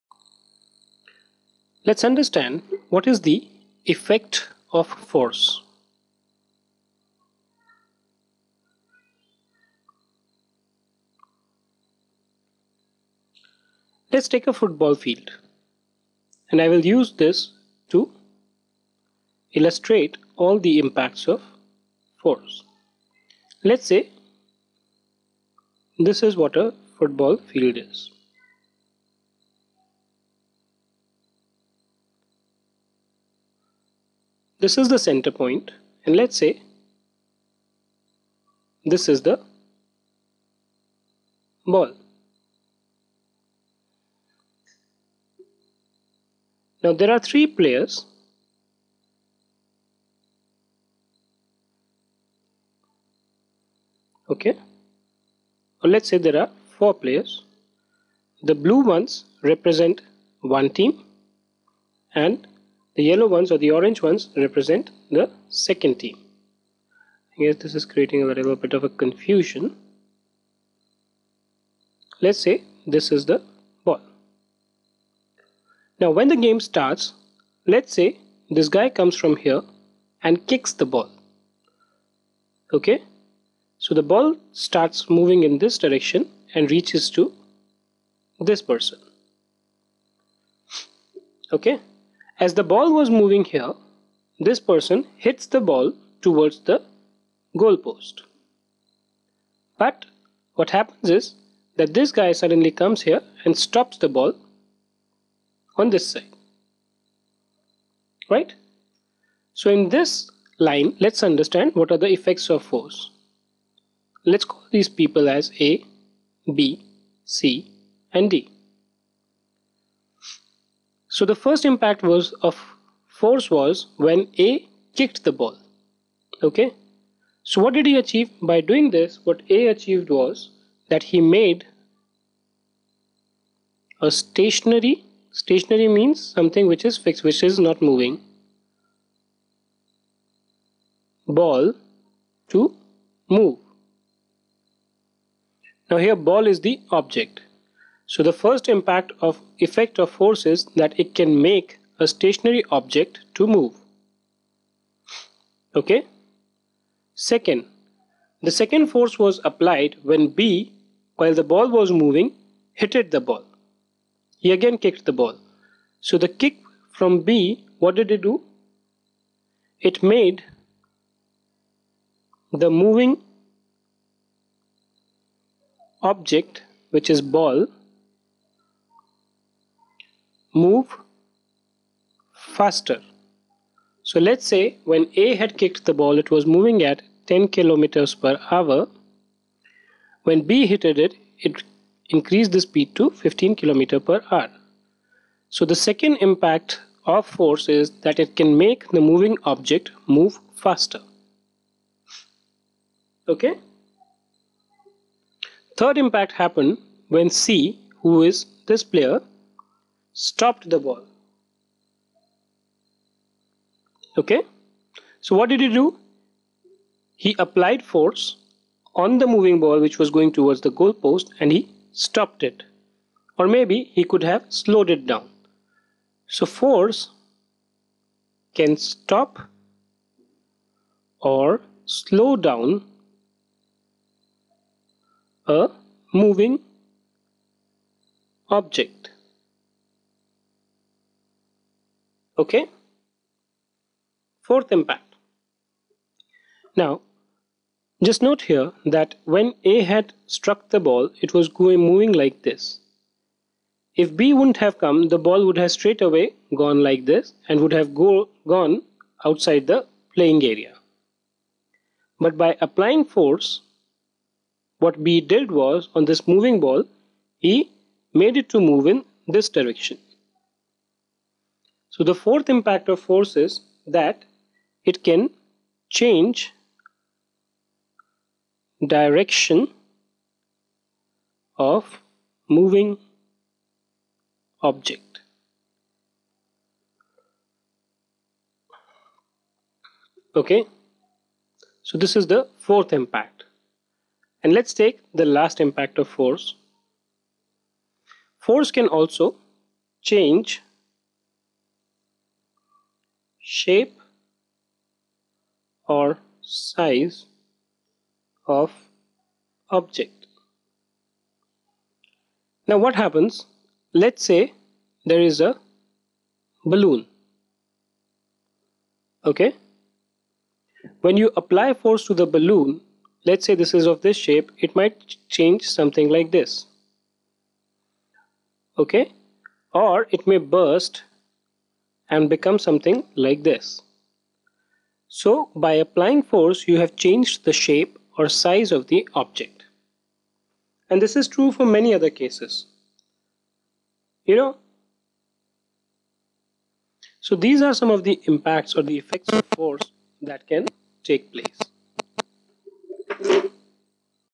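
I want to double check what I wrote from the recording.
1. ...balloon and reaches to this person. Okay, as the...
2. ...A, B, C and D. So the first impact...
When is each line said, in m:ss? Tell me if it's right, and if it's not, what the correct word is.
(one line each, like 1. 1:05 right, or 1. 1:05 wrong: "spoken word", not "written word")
1. 1:25 wrong: "direction", not "balloon"
2. 1:55 right.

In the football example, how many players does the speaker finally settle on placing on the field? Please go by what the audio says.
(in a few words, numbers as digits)
4.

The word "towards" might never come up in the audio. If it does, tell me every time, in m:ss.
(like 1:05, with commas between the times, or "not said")
1:36, 3:40.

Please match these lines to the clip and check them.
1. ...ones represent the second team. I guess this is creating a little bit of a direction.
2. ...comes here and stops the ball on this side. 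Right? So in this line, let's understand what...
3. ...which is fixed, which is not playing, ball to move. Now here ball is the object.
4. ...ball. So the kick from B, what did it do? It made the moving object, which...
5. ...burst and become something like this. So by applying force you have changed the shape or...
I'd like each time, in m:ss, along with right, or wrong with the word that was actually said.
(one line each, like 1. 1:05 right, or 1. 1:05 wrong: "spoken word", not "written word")
1. 1:04 wrong: "confusion", not "direction"
2. 1:42 right
3. 2:16 wrong: "moving", not "playing"
4. 2:45 right
5. 5:30 right.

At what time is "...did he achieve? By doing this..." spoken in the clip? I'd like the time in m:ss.
2:07.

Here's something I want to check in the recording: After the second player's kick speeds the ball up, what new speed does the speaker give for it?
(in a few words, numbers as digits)
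15 km/h.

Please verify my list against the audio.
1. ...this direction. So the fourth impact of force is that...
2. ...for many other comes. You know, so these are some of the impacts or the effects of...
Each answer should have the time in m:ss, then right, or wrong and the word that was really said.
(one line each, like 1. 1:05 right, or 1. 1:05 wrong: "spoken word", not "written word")
1. 4:29 right
2. 5:41 wrong: "cases", not "comes".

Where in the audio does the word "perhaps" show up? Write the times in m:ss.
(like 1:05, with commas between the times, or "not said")
not said.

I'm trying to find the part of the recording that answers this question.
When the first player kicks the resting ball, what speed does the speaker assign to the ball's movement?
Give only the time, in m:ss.
3:07.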